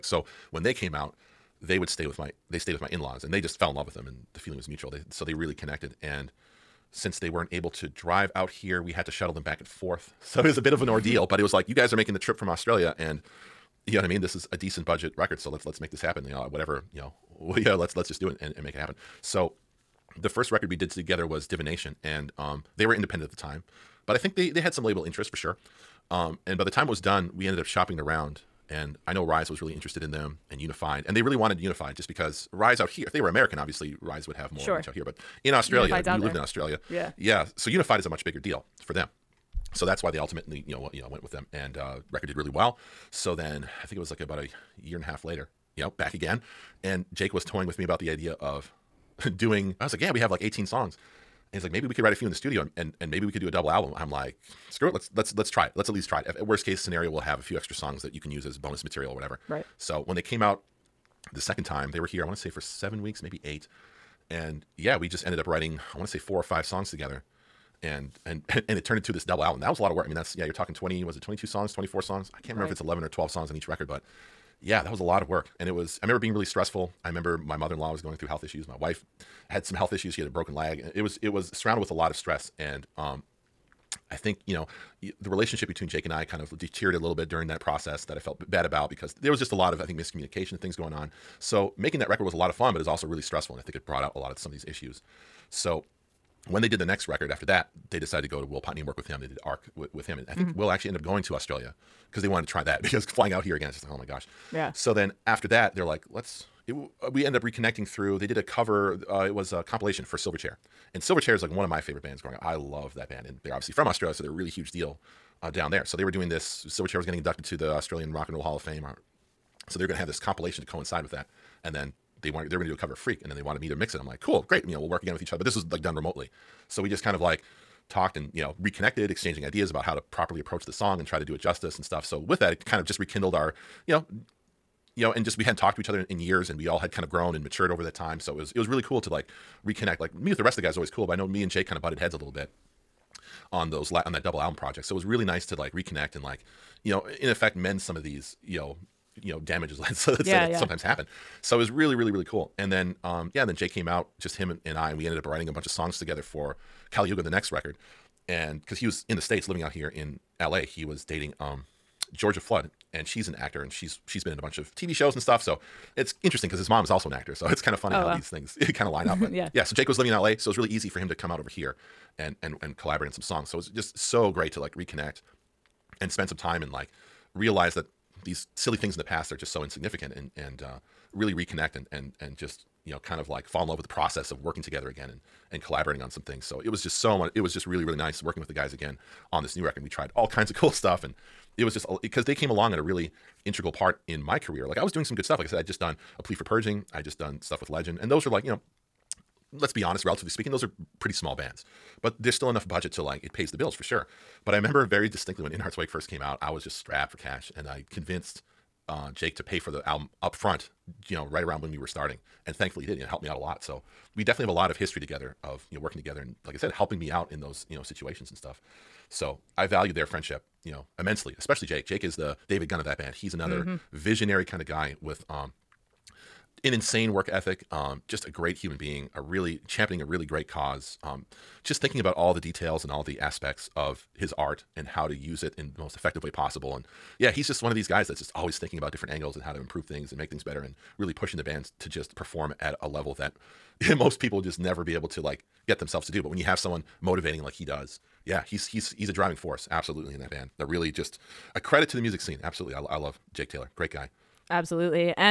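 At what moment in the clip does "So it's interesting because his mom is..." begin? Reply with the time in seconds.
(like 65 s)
165 s.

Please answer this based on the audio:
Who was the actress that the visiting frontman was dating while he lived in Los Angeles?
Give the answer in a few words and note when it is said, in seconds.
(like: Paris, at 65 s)
Georgia Flood, at 162 s.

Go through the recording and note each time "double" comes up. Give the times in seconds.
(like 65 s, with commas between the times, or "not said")
53 s, 69 s, 144 s.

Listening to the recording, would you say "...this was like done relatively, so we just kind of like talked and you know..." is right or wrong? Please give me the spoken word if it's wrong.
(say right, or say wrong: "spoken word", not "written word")
wrong: "remotely", not "relatively".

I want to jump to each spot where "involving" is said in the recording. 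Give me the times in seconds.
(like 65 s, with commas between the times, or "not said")
not said.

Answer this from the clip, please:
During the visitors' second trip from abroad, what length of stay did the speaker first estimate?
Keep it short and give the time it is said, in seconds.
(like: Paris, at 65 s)
7 weeks, at 62 s.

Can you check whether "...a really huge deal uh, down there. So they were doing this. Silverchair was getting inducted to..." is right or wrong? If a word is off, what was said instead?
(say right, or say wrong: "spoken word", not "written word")
right.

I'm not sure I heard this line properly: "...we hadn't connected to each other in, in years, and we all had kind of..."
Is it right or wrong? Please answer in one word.
wrong.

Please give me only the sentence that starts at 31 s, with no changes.
And they really wanted Unified just because Rise out here, if they were American, obviously Rise would have more sure.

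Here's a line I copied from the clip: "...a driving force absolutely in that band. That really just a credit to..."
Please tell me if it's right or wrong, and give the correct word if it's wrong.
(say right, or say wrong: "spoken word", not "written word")
right.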